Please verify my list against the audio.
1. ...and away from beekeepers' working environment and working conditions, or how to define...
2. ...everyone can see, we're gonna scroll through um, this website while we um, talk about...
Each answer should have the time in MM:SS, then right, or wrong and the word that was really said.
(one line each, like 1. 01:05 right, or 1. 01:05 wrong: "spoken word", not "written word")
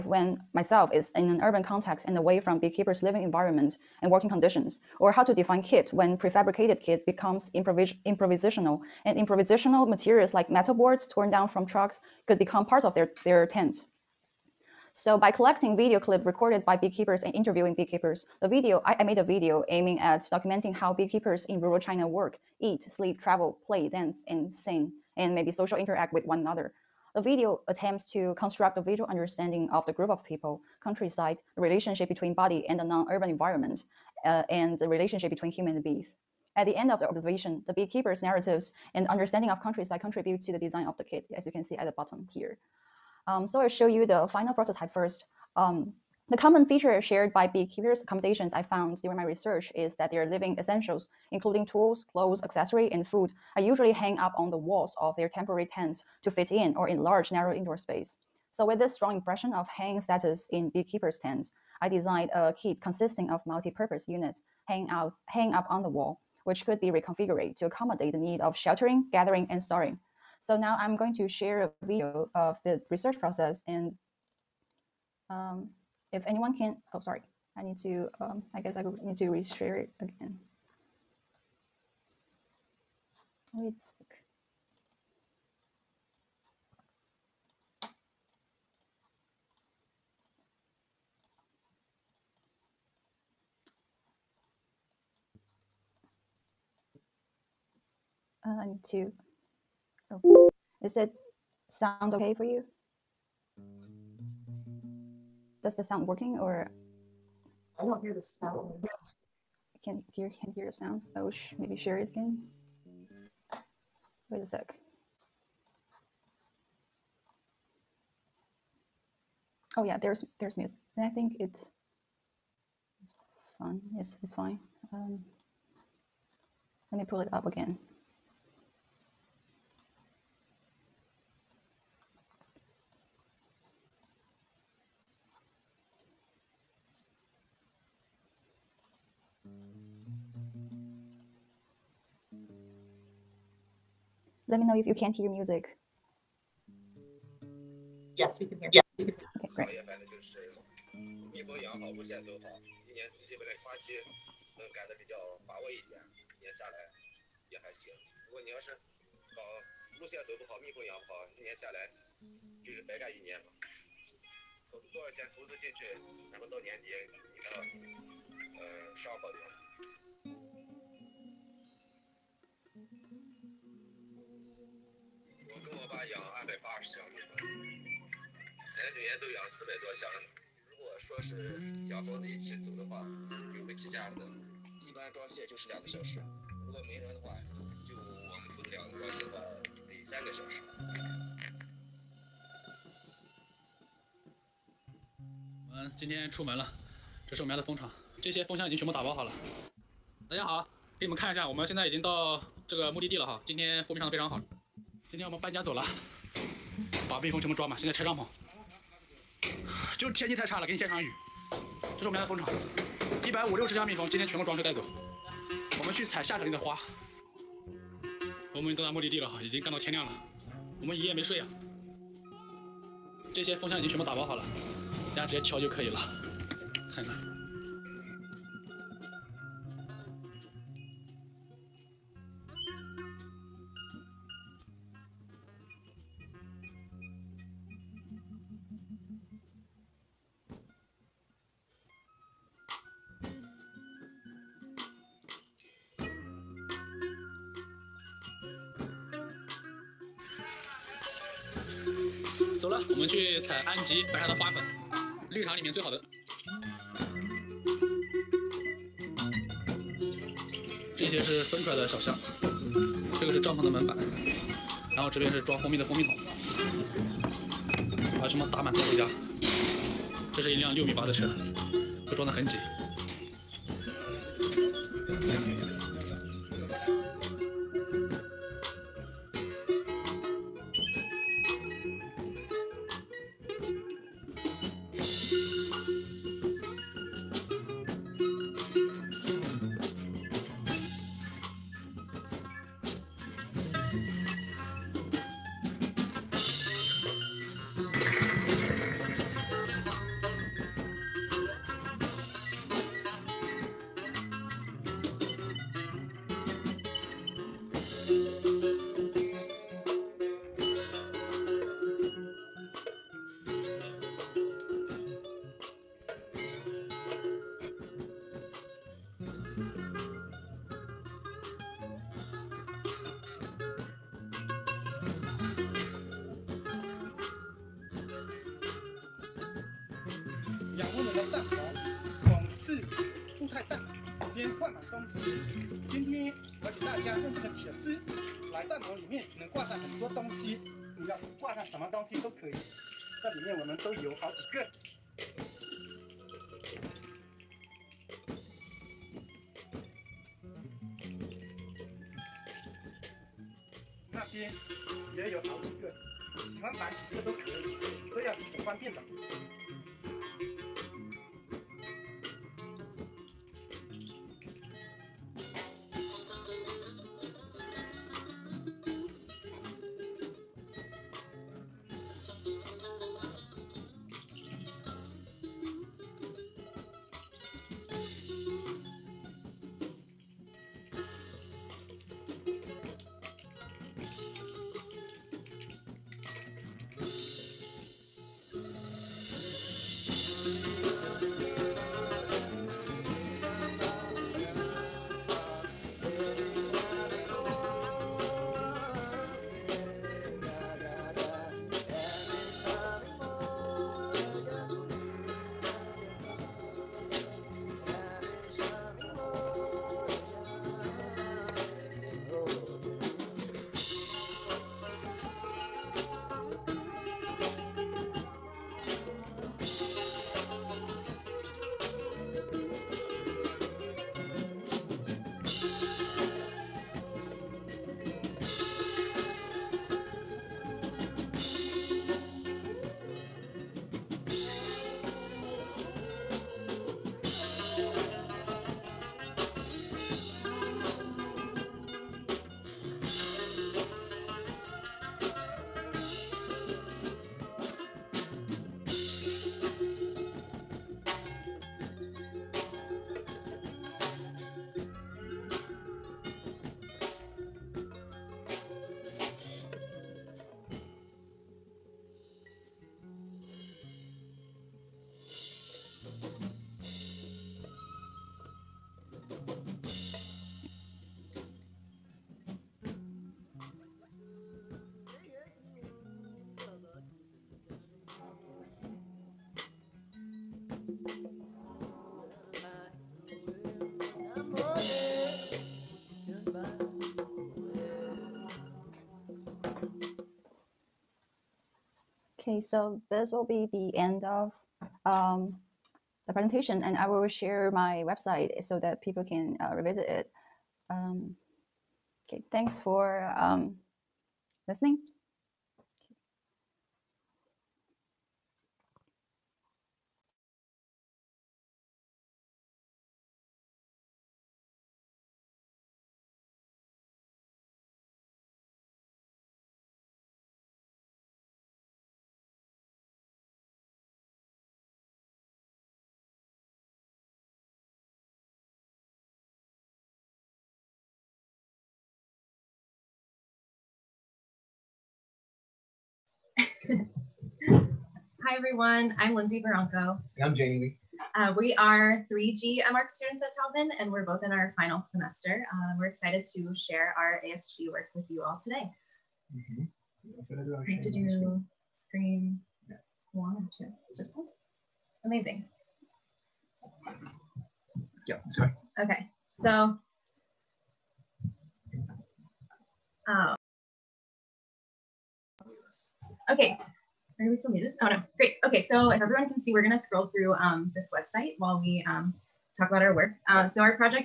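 1. 00:02 wrong: "living", not "working"
2. 09:29 right.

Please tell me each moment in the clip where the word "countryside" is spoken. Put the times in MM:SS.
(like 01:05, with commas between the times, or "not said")
00:30, 00:39.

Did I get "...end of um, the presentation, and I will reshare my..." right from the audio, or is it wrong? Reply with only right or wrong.
wrong.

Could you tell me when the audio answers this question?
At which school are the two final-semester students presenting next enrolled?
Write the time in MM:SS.
09:03.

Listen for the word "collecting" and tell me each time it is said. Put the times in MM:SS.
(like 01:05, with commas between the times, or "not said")
00:15.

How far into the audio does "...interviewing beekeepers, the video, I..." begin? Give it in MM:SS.
00:17.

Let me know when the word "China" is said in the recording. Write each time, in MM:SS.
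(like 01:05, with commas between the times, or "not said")
00:21.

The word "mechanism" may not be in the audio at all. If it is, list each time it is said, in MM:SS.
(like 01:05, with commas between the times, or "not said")
not said.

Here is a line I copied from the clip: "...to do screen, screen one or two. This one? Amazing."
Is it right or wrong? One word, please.
right.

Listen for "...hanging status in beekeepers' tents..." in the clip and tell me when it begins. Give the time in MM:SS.
00:59.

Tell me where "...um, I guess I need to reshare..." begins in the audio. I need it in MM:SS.
01:18.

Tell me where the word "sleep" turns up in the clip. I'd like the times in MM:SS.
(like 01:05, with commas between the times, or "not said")
00:22.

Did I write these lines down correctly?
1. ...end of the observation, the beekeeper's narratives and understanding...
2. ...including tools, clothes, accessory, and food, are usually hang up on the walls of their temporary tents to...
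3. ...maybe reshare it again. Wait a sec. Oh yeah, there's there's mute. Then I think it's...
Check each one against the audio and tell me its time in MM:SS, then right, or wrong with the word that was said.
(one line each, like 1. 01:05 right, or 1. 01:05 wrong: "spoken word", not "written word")
1. 00:36 right
2. 00:51 right
3. 01:51 wrong: "share", not "reshare".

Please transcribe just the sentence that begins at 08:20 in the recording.
Um, okay, thanks for um, listening.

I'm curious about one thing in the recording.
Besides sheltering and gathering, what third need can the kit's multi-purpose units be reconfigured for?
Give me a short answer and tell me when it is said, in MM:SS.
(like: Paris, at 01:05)
storing, at 01:09.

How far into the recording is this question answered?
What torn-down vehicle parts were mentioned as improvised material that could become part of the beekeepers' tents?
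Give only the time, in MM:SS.
00:10.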